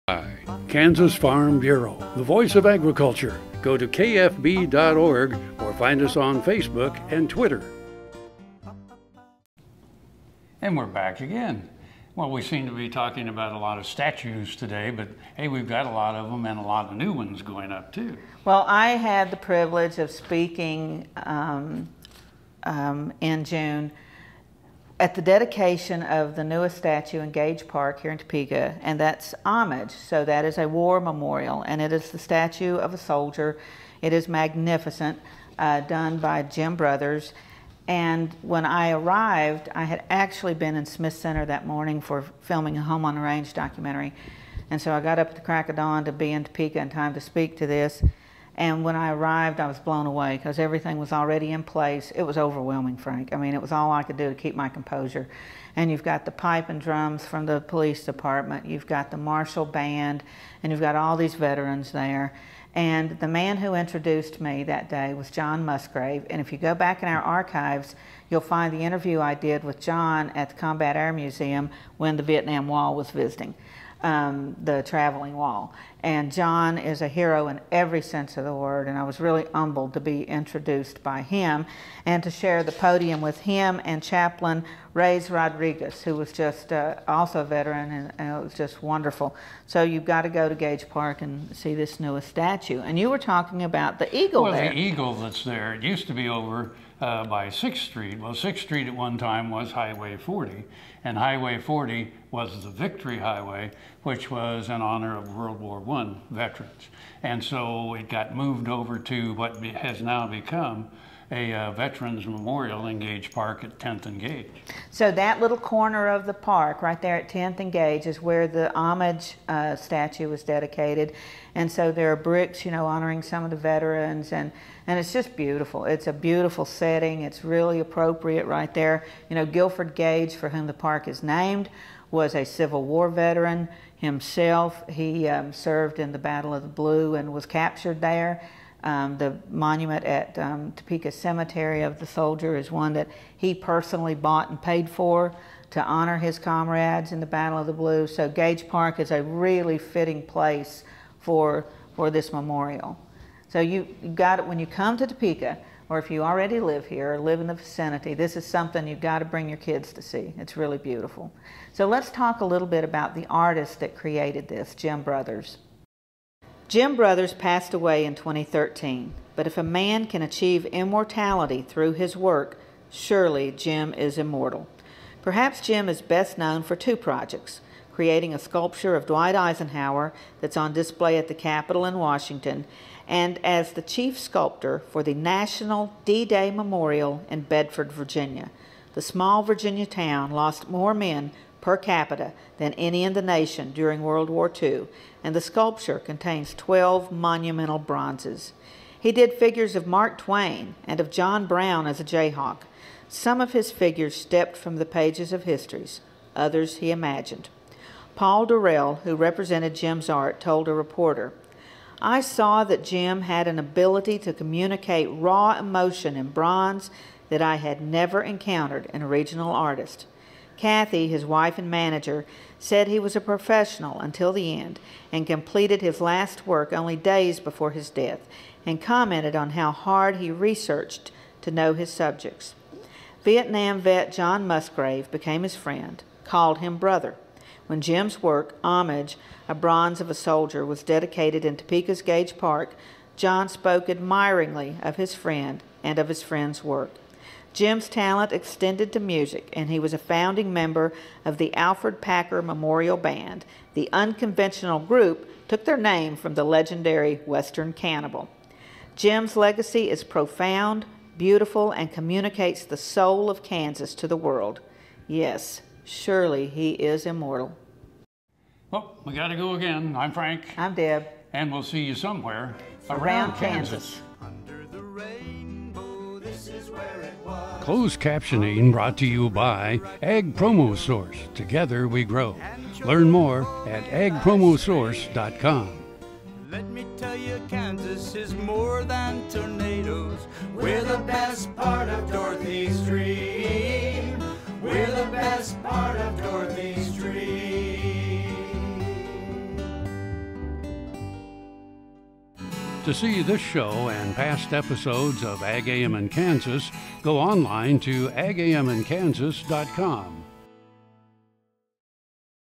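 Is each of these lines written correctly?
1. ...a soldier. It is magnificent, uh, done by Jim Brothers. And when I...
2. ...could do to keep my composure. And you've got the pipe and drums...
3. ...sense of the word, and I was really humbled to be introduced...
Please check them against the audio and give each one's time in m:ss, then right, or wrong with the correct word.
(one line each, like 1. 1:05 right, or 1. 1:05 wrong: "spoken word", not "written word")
1. 0:32 right
2. 0:54 right
3. 1:18 right.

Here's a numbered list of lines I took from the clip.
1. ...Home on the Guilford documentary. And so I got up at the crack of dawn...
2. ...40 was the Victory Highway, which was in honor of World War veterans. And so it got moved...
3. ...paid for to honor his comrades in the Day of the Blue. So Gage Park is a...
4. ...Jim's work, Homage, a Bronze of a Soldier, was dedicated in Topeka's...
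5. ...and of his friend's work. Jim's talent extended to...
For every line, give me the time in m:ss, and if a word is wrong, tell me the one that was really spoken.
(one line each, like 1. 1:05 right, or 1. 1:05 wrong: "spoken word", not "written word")
1. 0:42 wrong: "Range", not "Guilford"
2. 1:41 right
3. 2:24 wrong: "Battle", not "Day"
4. 3:57 right
5. 4:05 right.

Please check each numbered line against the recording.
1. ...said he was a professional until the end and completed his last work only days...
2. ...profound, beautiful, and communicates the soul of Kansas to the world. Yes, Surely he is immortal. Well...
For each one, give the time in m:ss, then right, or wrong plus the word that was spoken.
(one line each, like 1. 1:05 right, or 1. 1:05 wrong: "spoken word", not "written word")
1. 3:42 right
2. 4:20 right.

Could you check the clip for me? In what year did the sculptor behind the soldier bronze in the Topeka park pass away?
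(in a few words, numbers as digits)
2013.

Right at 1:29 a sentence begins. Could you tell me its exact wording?
So you've got to go to Gage Park and see this newest statue.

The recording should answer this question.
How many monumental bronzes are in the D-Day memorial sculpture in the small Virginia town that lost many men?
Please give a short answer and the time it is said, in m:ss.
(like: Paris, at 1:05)
12, at 3:16.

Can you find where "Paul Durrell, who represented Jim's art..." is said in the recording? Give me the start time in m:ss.
3:28.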